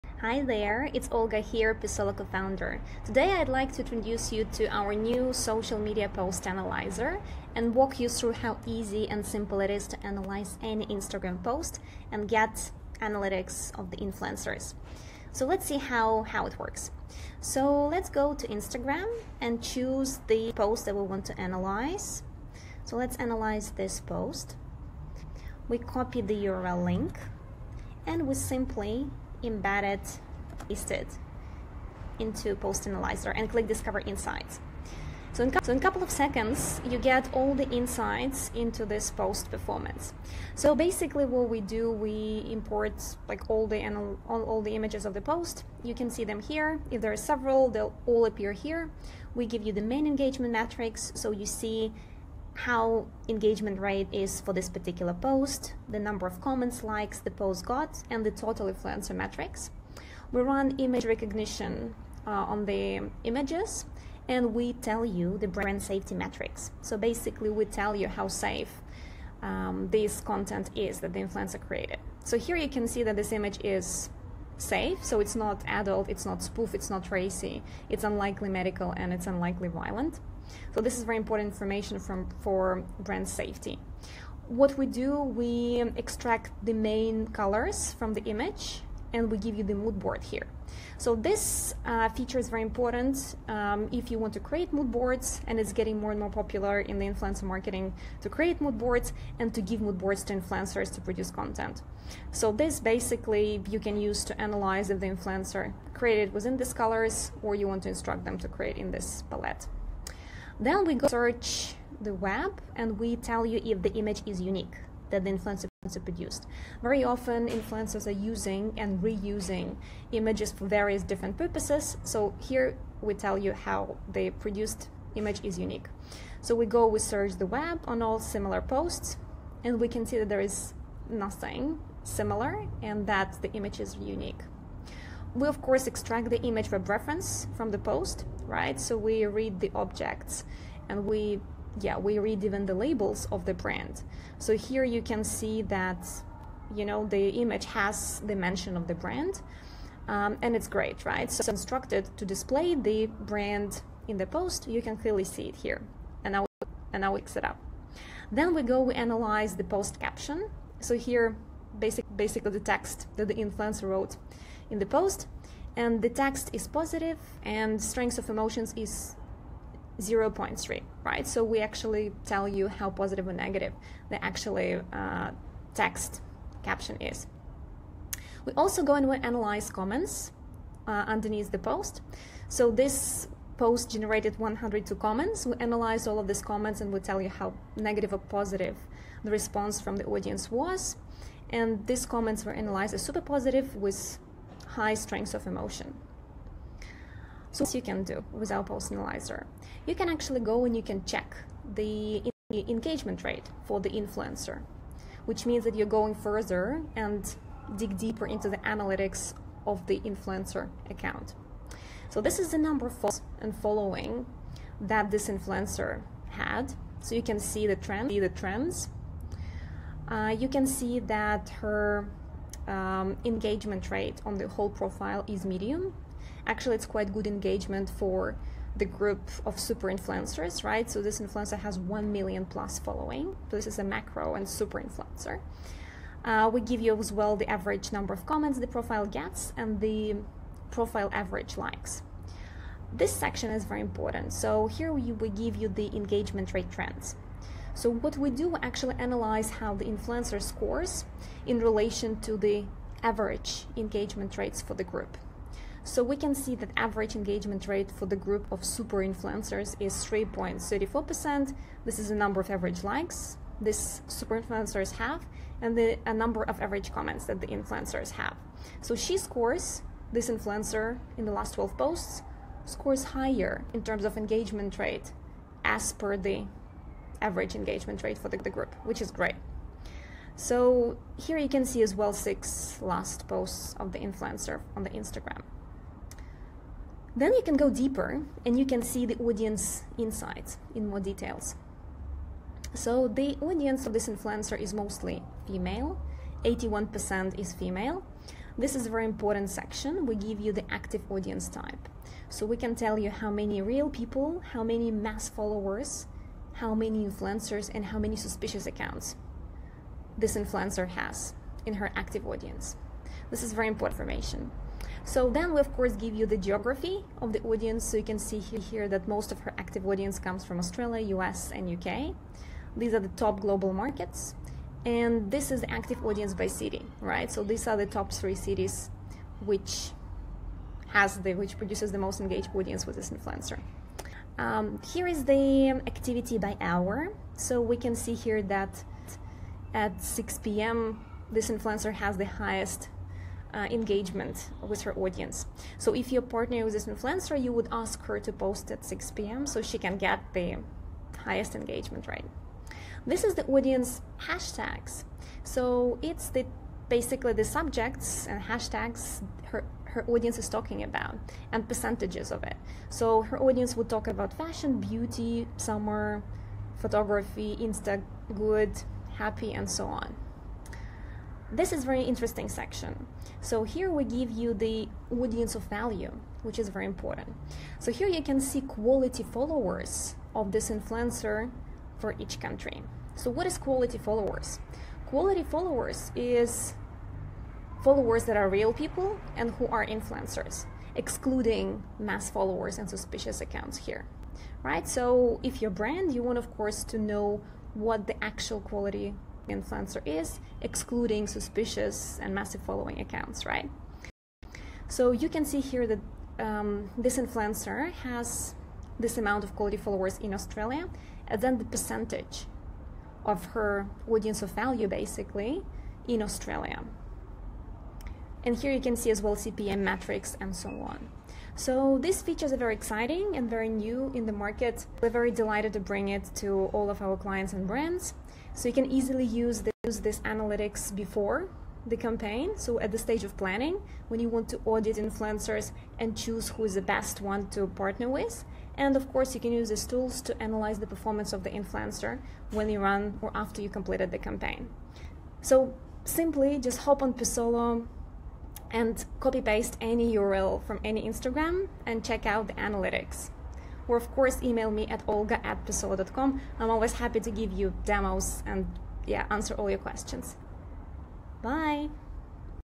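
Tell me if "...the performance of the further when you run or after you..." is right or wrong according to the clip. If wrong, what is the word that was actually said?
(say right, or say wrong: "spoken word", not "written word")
wrong: "influencer", not "further".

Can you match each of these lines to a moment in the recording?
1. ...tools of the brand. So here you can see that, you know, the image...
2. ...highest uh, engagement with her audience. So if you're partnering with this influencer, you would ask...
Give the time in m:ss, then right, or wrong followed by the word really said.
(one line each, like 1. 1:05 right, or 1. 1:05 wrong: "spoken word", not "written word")
1. 2:22 wrong: "labels", not "tools"
2. 5:42 right.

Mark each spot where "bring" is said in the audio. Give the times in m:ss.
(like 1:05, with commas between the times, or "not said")
7:05.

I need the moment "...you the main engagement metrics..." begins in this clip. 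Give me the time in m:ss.
0:49.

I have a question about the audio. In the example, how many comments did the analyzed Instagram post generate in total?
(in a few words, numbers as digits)
102.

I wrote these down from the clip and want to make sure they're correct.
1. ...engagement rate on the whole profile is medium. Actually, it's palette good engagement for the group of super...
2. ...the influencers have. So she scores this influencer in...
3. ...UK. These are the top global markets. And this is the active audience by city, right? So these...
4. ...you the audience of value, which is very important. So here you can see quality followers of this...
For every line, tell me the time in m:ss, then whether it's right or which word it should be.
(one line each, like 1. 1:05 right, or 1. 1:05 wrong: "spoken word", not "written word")
1. 3:43 wrong: "quite", not "palette"
2. 4:27 right
3. 5:21 right
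4. 6:14 right.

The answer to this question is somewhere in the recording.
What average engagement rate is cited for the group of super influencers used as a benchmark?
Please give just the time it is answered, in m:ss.
4:19.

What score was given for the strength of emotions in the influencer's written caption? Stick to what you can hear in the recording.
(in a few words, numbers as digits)
0.3.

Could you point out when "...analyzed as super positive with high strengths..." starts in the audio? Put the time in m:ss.
3:12.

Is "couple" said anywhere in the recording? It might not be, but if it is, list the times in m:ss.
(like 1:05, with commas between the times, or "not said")
0:35.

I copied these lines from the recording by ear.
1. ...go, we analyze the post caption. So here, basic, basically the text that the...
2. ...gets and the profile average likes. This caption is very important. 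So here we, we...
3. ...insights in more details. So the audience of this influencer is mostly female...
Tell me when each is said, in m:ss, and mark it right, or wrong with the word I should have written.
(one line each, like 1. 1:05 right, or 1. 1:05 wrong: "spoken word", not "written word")
1. 2:38 right
2. 3:59 wrong: "section", not "caption"
3. 4:49 right.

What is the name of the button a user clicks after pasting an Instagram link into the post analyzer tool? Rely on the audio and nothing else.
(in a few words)
Discover Insights.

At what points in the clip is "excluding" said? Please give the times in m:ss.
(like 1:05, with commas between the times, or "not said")
6:30, 6:40.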